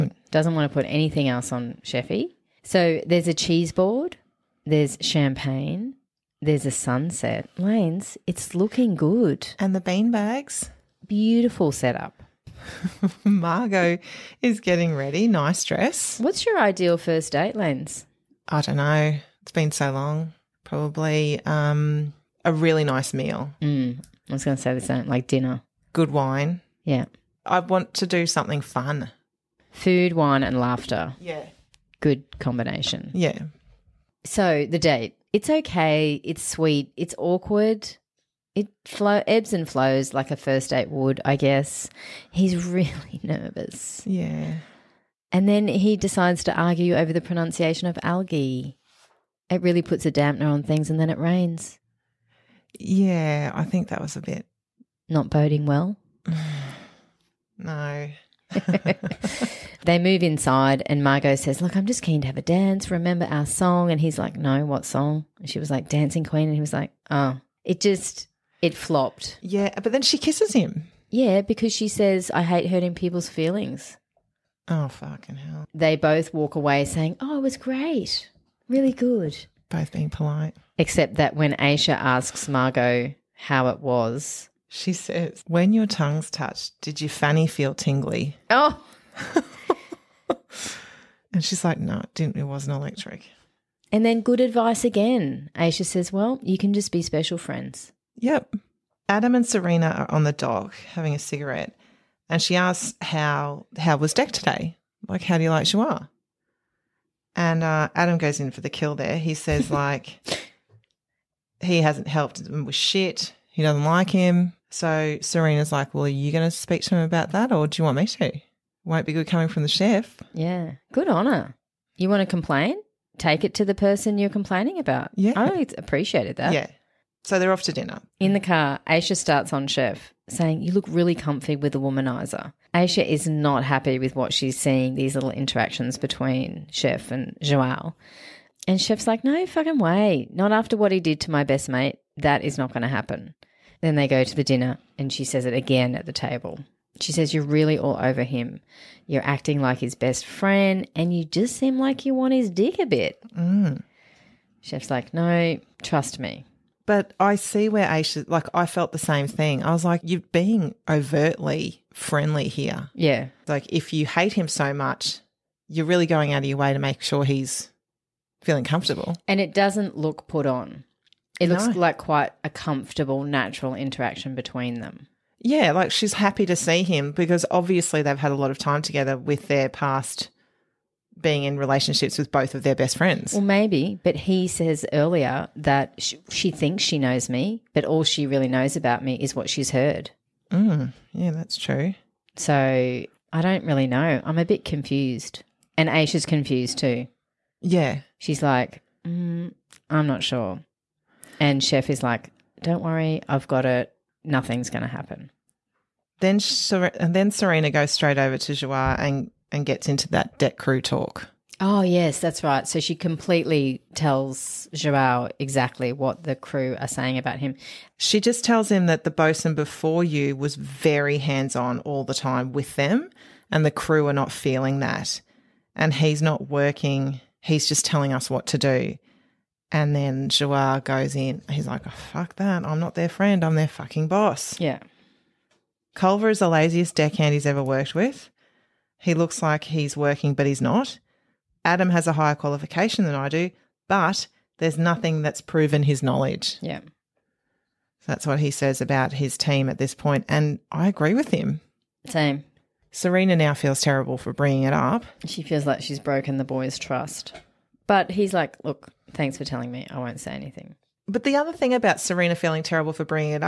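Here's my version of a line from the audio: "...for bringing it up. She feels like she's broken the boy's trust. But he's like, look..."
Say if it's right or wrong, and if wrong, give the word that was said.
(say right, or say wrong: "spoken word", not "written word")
right.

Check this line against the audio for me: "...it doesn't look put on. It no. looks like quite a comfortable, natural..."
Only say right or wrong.
right.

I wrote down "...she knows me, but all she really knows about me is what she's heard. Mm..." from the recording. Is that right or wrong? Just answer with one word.
right.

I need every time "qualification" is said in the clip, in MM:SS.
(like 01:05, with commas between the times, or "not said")
04:02.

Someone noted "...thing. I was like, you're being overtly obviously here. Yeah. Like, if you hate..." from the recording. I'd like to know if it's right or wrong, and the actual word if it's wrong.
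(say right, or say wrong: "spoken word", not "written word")
wrong: "friendly", not "obviously".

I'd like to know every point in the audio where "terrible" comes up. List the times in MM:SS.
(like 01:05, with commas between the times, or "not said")
04:13, 04:22.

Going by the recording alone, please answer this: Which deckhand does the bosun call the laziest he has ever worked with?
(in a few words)
Culver.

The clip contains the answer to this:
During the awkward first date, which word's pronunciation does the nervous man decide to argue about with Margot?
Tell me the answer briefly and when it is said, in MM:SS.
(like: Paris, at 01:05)
Algae, at 00:48.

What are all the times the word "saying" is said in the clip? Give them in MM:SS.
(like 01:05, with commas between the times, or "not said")
01:16, 02:10, 03:36.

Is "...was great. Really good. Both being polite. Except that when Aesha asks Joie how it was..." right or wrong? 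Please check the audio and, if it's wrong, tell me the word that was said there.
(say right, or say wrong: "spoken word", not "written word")
wrong: "Margot", not "Joie".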